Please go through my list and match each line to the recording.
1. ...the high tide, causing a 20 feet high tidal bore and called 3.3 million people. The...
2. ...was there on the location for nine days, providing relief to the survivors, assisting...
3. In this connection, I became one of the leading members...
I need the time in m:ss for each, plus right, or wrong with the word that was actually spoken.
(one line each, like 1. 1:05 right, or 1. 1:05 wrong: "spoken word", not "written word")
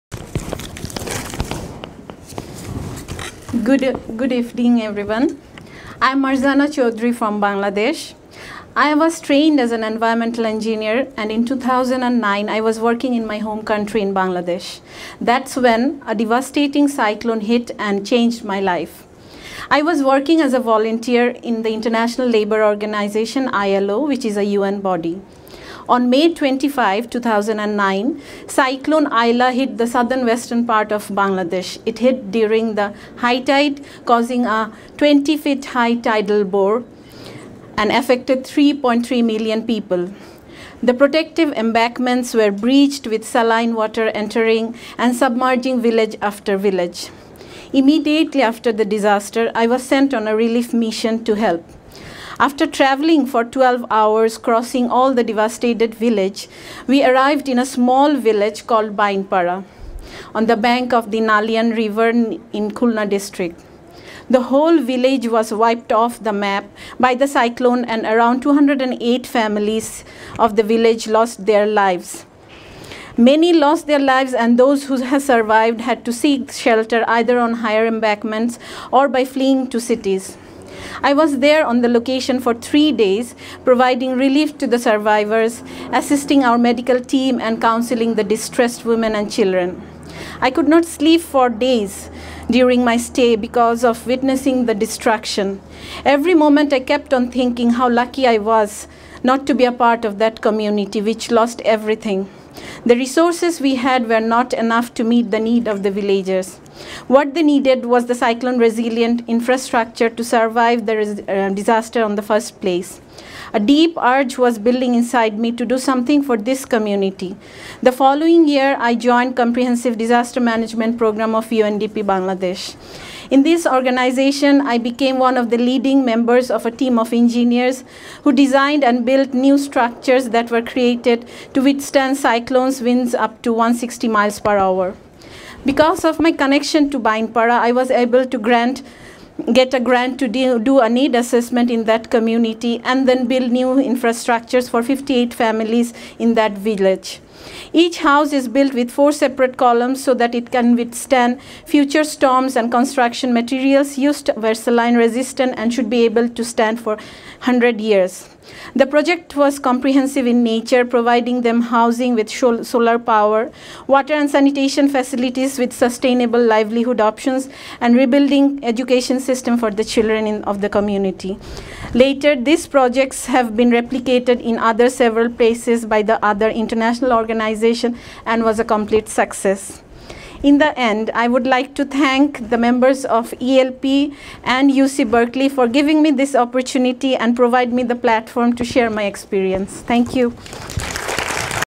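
1. 0:32 wrong: "affected", not "called"
2. 1:21 wrong: "three", not "nine"
3. 2:03 wrong: "organization", not "connection".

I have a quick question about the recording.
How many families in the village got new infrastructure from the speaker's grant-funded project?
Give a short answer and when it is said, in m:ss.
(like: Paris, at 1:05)
58, at 2:24.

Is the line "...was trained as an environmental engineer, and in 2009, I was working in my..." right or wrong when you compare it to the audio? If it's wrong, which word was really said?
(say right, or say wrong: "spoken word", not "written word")
right.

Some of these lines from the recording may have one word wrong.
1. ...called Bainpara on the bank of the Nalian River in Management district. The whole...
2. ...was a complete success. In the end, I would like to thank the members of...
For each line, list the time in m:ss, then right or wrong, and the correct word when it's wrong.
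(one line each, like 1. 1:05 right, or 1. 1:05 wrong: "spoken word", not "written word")
1. 0:58 wrong: "Khulna", not "Management"
2. 2:58 right.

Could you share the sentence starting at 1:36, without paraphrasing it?
Every moment I kept on thinking how lucky I was not to be a part of that community which lost everything.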